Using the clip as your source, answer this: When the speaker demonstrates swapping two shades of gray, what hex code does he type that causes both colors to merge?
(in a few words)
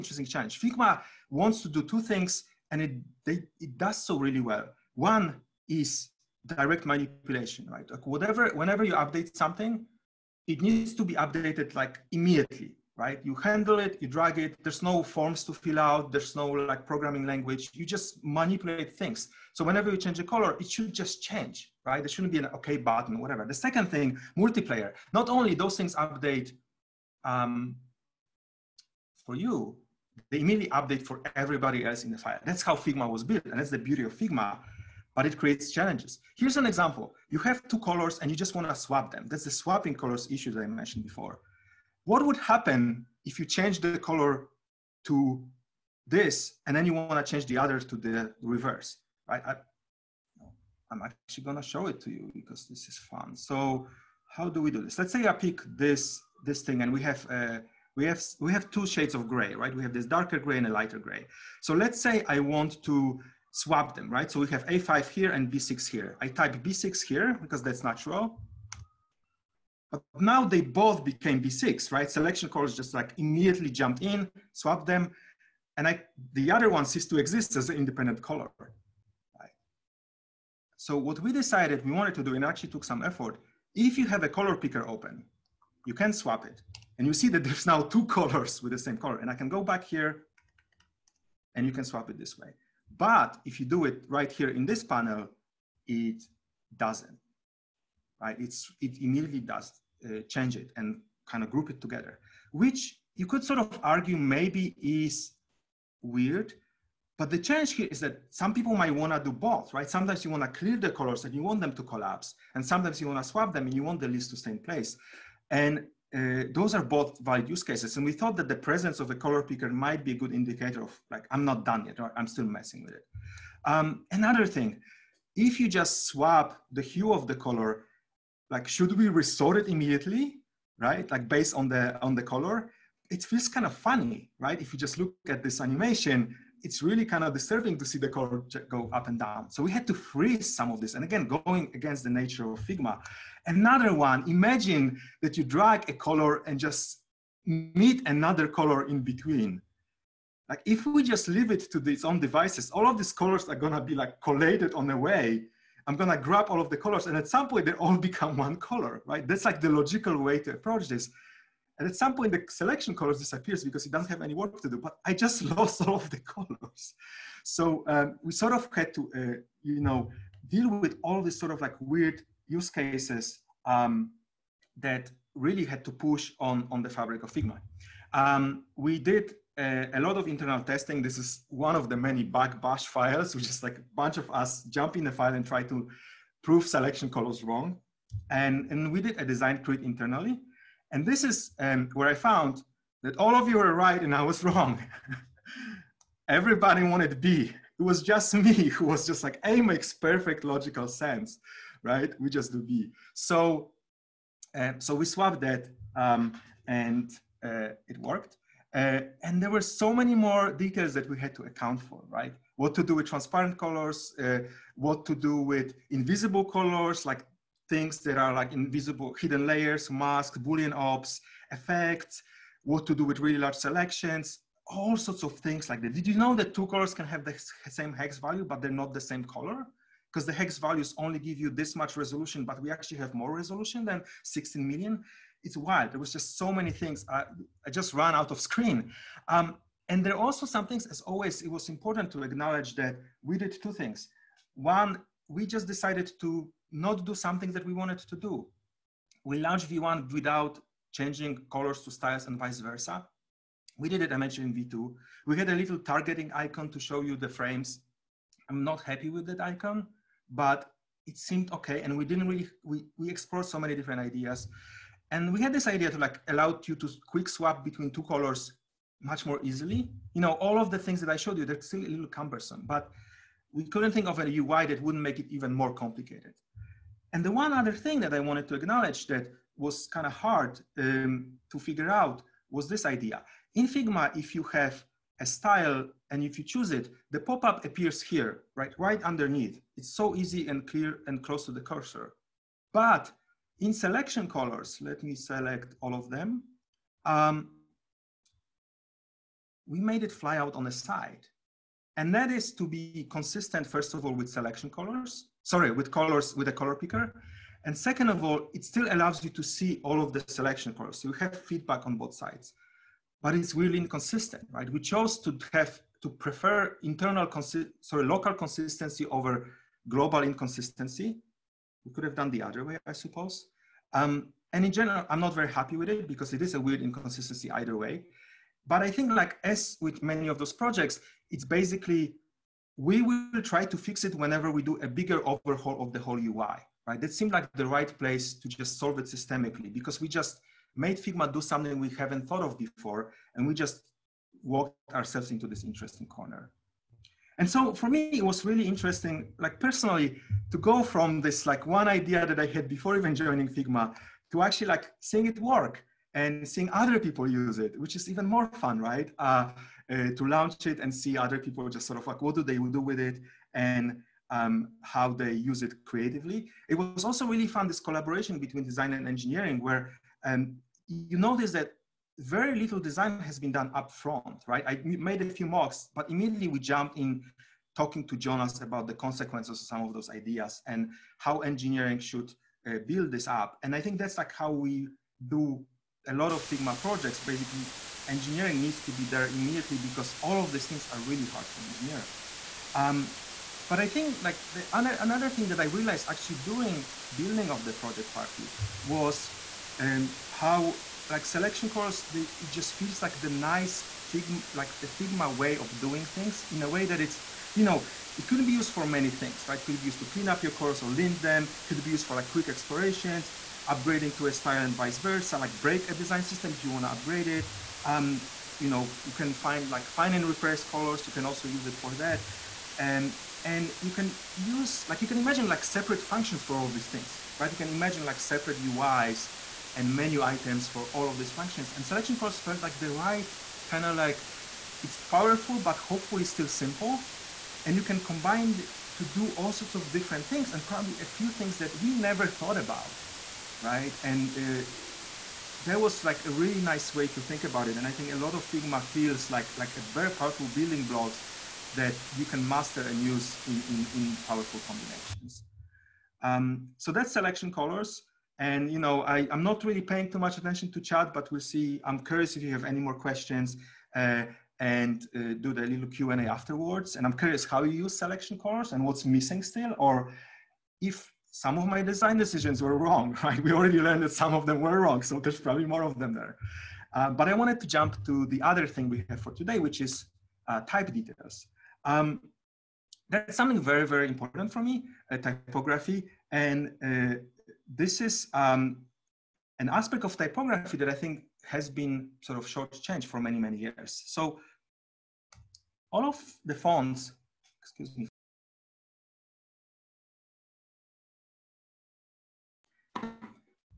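B6.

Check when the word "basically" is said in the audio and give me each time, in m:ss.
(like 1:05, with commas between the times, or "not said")
5:31, 6:27.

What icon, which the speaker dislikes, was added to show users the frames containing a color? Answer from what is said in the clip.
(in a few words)
targeting icon.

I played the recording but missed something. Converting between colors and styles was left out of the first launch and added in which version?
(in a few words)
V2.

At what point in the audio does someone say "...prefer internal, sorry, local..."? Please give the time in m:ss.
5:16.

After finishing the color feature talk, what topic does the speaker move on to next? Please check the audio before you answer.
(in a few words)
type details.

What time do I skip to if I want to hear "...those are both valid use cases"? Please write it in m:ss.
1:56.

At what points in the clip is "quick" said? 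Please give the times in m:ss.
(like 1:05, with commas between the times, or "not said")
4:27, 6:52.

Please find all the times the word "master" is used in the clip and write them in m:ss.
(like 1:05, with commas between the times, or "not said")
7:32.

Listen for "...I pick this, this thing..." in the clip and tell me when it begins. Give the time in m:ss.
0:55.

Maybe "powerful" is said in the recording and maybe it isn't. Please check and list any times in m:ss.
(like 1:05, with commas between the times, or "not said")
7:14, 7:30, 7:34.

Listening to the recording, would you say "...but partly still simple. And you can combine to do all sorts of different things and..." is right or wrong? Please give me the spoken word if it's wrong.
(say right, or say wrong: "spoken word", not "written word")
wrong: "hopefully", not "partly".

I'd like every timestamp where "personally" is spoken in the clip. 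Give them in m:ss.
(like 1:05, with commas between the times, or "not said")
5:49.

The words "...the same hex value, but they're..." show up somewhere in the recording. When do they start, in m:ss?
3:47.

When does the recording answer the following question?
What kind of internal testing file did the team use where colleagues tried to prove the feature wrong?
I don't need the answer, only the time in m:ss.
3:02.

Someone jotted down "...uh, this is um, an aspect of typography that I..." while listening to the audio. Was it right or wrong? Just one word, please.
right.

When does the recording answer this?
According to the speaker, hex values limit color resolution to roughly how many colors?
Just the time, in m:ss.
3:54.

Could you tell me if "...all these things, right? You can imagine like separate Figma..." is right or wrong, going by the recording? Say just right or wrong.
wrong.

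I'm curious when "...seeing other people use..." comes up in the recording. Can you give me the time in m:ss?
5:56.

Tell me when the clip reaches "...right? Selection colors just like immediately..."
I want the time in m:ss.
1:11.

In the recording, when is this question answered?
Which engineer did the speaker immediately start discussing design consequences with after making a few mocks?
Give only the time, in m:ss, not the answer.
6:18.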